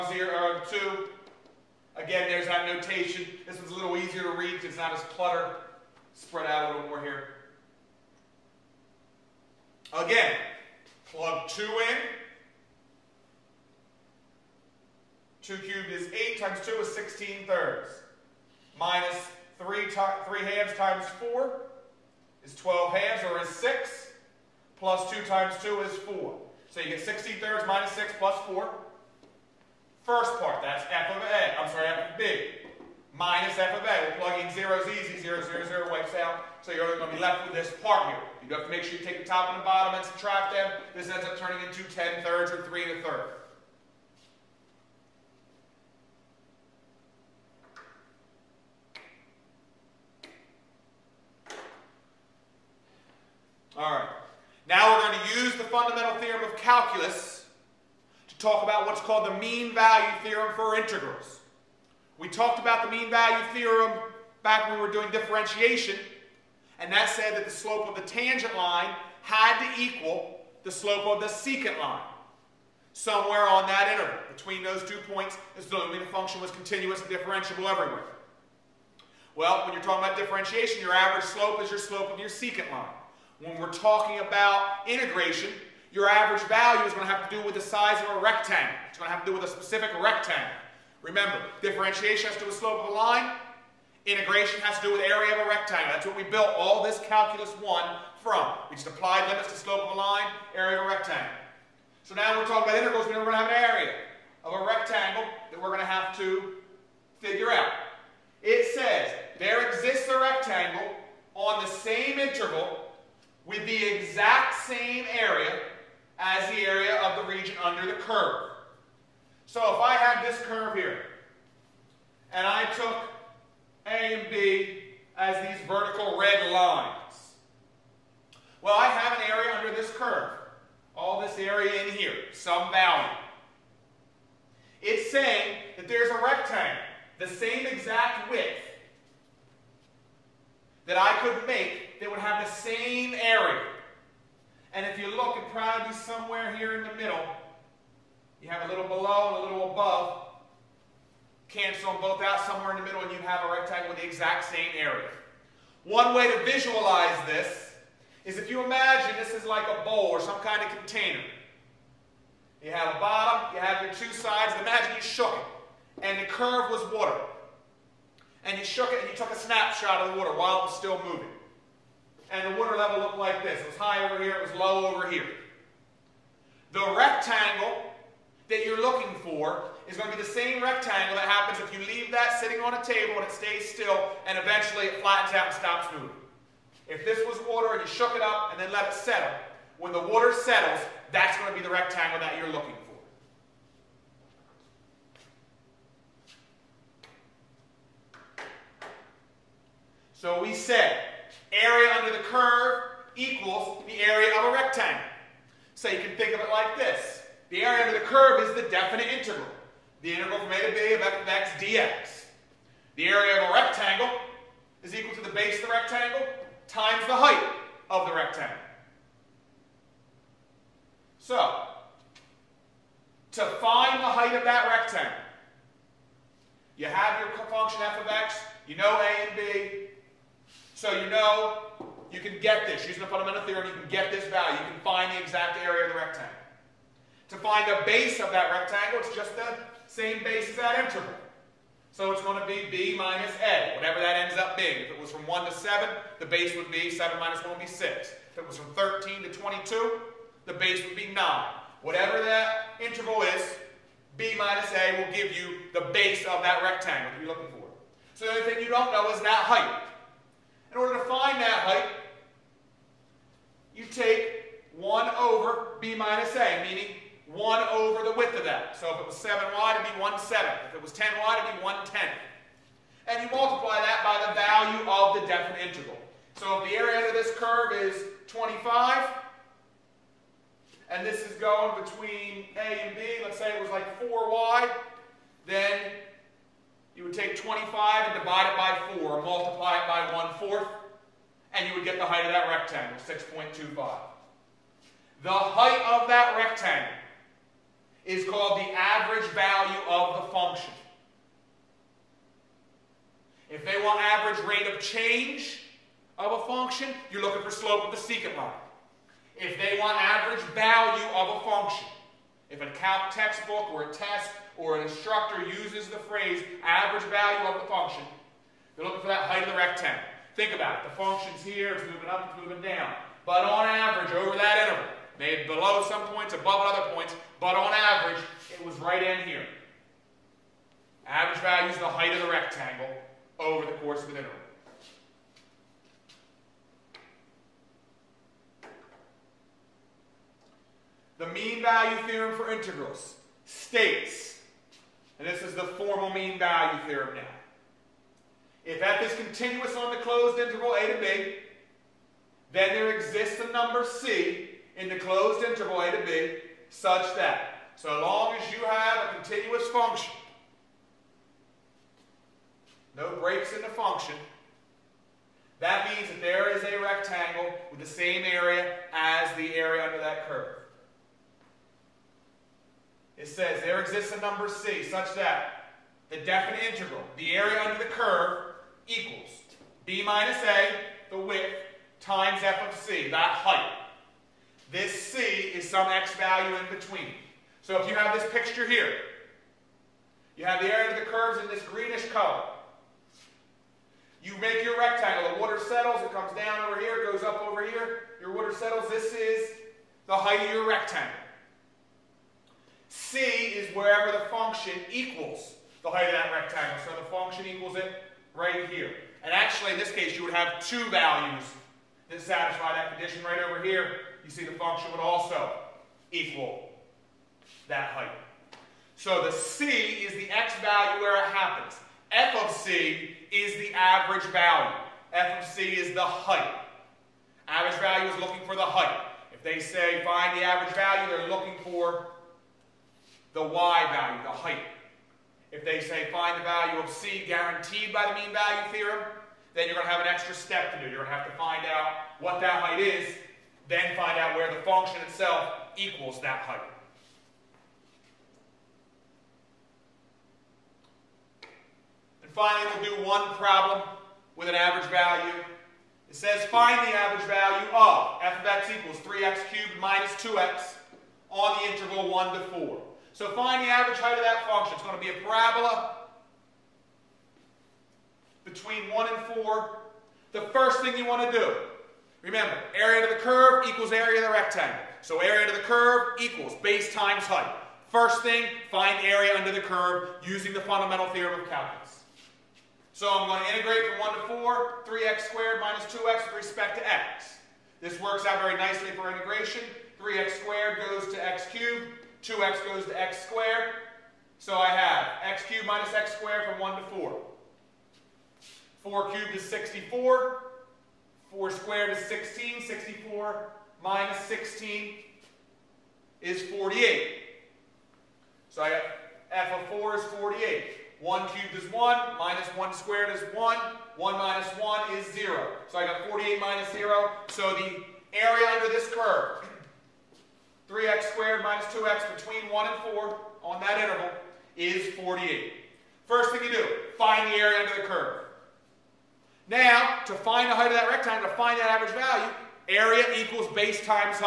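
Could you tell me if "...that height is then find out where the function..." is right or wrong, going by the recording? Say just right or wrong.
right.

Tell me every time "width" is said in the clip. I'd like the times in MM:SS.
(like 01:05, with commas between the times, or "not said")
04:28, 06:21.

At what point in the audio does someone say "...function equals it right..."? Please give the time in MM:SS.
06:47.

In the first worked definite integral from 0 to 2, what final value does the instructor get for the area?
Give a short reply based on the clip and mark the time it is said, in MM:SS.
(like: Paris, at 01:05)
10/3, at 00:41.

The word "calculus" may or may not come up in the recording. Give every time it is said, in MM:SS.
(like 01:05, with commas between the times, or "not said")
00:56, 01:37, 08:01.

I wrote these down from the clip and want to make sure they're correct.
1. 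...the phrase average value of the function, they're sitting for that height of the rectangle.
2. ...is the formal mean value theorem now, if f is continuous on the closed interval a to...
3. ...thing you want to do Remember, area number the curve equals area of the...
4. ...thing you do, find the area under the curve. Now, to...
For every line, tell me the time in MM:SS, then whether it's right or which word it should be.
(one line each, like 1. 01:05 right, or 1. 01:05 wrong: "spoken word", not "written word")
1. 05:15 wrong: "looking", not "sitting"
2. 05:45 right
3. 07:50 wrong: "under", not "number"
4. 08:46 right.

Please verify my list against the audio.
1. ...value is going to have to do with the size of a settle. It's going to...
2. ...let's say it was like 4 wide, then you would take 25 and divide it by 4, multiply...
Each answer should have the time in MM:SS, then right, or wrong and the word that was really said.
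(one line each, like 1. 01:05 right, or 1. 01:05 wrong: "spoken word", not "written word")
1. 01:26 wrong: "rectangle", not "settle"
2. 04:43 right.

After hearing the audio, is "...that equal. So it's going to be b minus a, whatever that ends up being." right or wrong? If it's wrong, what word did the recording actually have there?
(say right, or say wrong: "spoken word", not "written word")
wrong: "interval", not "equal".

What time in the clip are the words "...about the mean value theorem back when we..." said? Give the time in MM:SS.
01:02.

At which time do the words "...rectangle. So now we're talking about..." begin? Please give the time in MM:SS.
01:40.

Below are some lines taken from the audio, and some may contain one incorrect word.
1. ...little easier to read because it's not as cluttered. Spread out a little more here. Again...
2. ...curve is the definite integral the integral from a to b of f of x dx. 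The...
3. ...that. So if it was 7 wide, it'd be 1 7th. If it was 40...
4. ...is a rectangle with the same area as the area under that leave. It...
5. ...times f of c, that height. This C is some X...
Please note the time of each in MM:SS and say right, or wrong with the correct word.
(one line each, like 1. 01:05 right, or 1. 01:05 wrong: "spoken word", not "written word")
1. 00:03 right
2. 03:28 right
3. 04:28 wrong: "10", not "40"
4. 06:06 wrong: "curve", not "leave"
5. 06:22 right.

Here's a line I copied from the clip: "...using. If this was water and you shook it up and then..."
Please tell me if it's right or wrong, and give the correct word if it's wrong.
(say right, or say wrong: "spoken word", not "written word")
wrong: "moving", not "using".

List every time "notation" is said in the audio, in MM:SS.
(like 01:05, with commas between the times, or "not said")
00:02.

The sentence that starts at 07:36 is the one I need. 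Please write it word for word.
It says find the average value of f of x equals 3x cubed minus 2x on the interval 1 to 4.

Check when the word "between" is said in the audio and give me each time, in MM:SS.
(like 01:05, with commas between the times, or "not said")
01:14, 04:41, 06:26, 07:48, 08:42.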